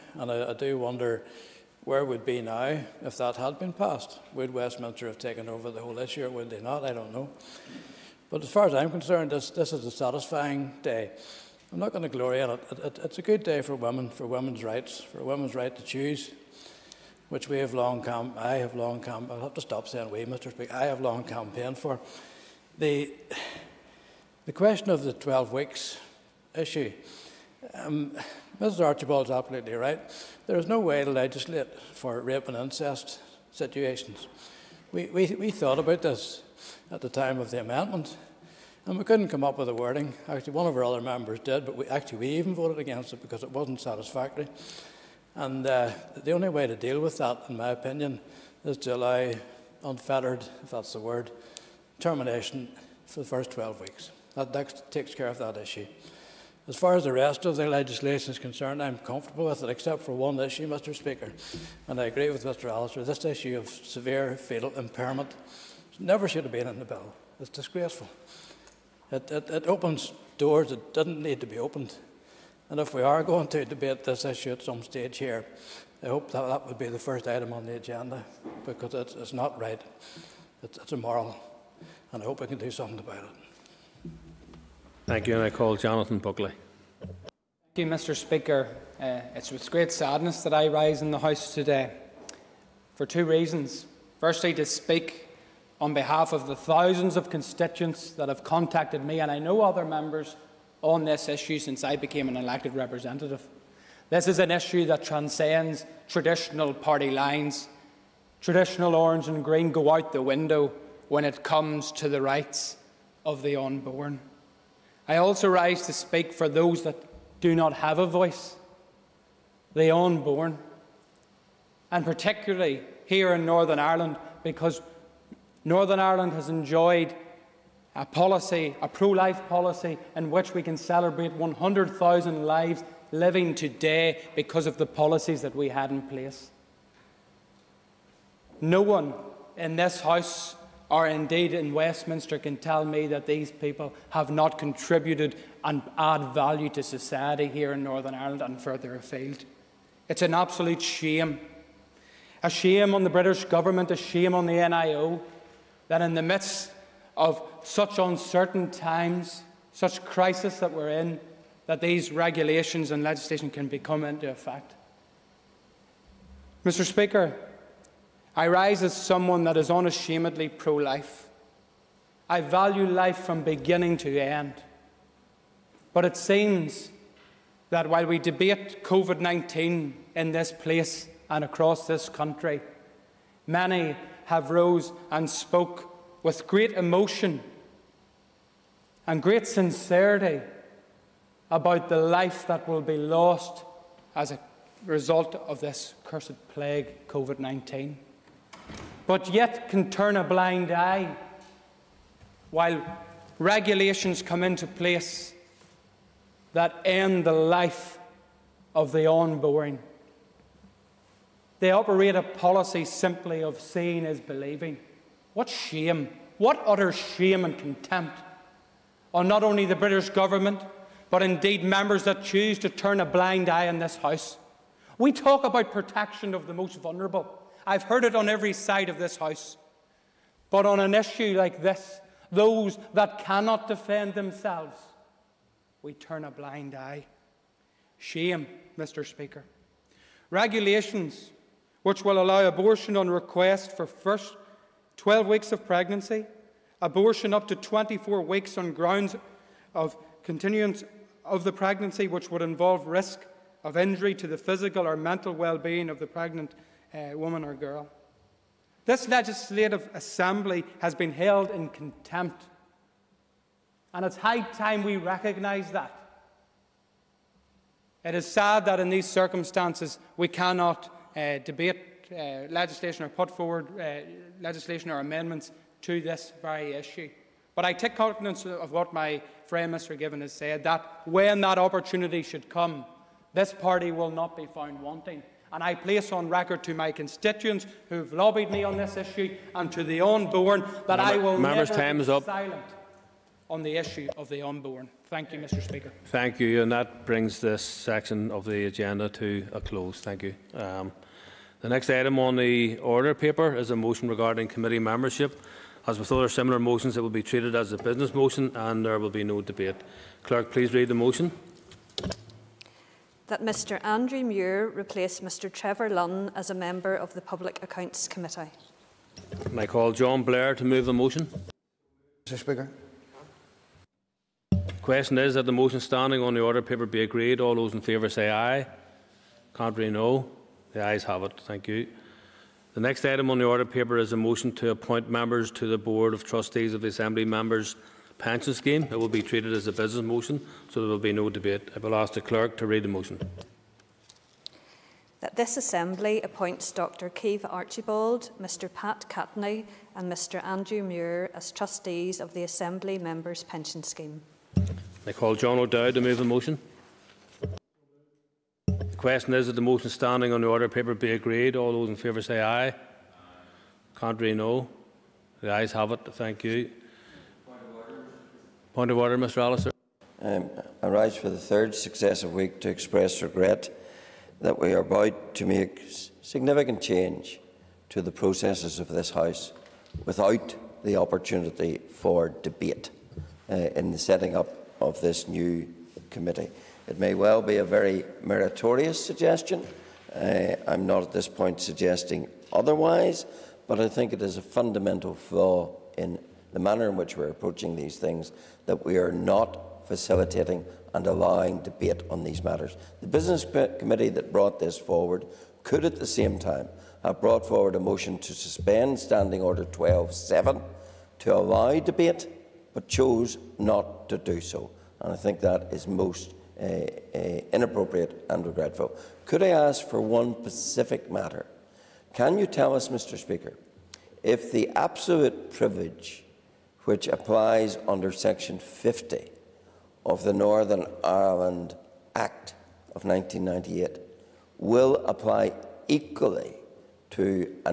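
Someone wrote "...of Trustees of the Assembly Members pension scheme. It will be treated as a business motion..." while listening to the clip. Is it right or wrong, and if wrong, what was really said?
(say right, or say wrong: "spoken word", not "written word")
right.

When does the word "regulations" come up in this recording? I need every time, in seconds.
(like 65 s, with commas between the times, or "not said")
162 s, 203 s, 240 s.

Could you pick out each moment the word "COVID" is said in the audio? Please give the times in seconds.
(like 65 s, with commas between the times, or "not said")
178 s, 197 s.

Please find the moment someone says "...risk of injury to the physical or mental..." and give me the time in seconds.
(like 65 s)
252 s.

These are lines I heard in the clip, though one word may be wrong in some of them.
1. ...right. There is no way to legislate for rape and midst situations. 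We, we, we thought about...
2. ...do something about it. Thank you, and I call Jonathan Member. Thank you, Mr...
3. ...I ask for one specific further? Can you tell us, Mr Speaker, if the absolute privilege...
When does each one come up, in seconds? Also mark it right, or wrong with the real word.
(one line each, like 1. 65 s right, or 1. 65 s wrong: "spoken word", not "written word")
1. 29 s wrong: "incest", not "midst"
2. 82 s wrong: "Buckley", not "Member"
3. 419 s wrong: "matter", not "further".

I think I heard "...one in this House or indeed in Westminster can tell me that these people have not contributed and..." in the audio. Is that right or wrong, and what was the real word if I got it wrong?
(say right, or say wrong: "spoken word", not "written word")
right.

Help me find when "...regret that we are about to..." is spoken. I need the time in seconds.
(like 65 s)
373 s.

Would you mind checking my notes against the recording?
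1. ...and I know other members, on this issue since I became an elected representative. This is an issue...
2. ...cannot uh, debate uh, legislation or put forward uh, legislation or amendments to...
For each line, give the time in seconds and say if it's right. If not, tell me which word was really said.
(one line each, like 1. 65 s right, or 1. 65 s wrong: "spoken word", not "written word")
1. 99 s right
2. 270 s right.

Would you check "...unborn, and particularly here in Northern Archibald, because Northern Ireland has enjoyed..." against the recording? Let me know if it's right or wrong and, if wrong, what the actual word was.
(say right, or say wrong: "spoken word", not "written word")
wrong: "Ireland", not "Archibald".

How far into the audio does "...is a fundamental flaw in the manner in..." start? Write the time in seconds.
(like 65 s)
394 s.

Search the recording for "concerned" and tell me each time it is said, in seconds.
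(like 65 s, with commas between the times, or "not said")
8 s, 58 s.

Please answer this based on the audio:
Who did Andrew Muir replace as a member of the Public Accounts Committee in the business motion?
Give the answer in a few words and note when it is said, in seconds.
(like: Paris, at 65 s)
Trevor Lunn, at 315 s.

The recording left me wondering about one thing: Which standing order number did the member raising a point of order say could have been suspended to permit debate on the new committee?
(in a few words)
12.7.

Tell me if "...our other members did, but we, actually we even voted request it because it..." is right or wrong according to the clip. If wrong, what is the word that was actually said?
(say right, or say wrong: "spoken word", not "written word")
wrong: "against", not "request".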